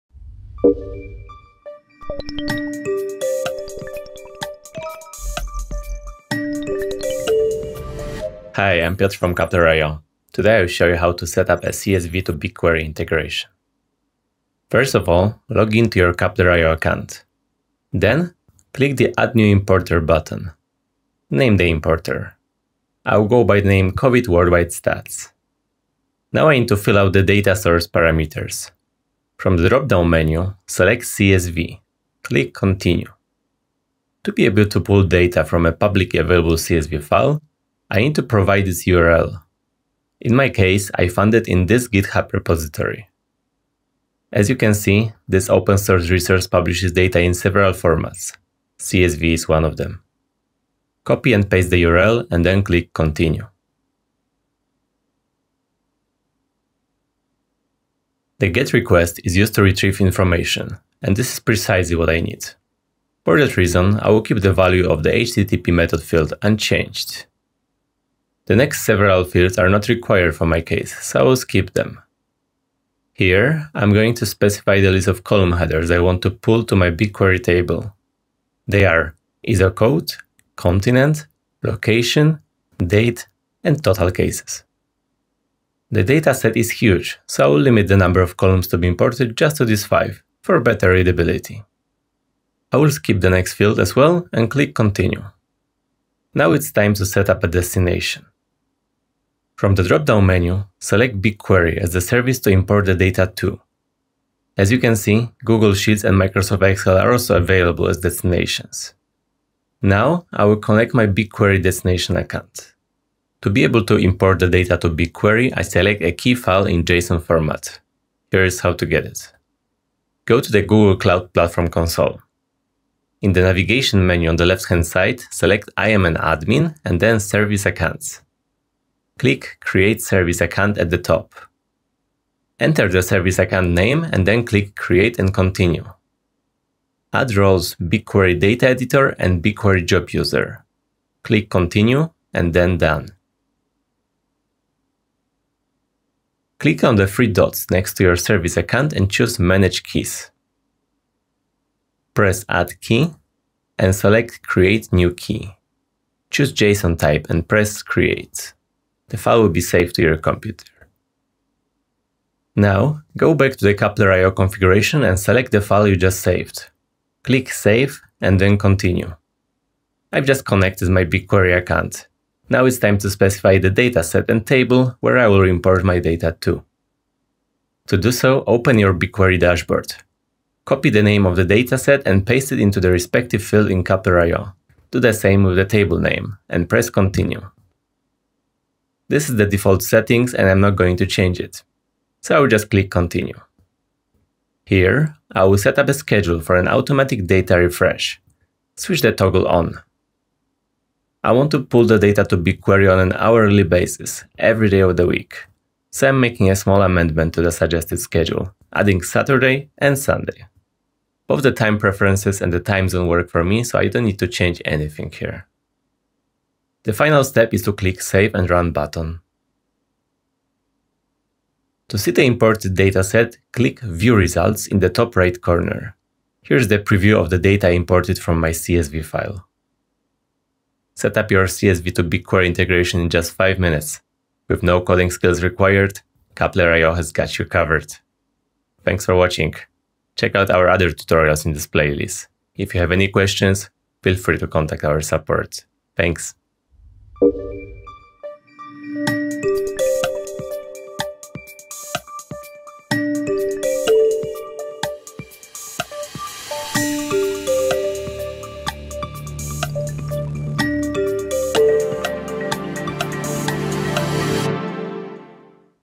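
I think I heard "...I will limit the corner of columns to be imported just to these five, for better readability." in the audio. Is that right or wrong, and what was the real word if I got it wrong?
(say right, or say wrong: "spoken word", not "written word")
wrong: "number", not "corner".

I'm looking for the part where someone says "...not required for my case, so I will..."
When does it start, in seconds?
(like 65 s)
69 s.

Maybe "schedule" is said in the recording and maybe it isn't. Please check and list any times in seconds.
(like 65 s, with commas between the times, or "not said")
195 s, 207 s.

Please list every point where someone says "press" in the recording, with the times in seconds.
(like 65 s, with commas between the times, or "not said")
152 s, 157 s, 186 s.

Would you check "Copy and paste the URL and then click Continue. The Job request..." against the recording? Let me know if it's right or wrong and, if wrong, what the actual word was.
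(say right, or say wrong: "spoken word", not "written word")
wrong: "GET", not "Job".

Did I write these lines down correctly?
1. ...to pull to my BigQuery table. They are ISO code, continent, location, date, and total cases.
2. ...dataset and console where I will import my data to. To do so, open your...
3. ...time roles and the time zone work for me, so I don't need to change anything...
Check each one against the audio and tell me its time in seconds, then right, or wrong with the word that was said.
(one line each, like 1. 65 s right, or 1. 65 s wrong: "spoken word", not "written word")
1. 76 s right
2. 173 s wrong: "table", not "console"
3. 211 s wrong: "preferences", not "roles".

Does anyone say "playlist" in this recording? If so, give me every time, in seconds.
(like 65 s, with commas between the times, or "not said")
241 s.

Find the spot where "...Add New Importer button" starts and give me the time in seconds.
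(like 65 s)
19 s.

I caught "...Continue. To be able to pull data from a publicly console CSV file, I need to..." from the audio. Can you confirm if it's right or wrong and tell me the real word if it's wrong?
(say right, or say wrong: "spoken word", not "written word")
wrong: "available", not "console".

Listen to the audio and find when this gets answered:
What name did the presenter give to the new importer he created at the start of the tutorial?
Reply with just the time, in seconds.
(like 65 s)
23 s.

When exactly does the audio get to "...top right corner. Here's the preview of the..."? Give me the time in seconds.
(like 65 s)
224 s.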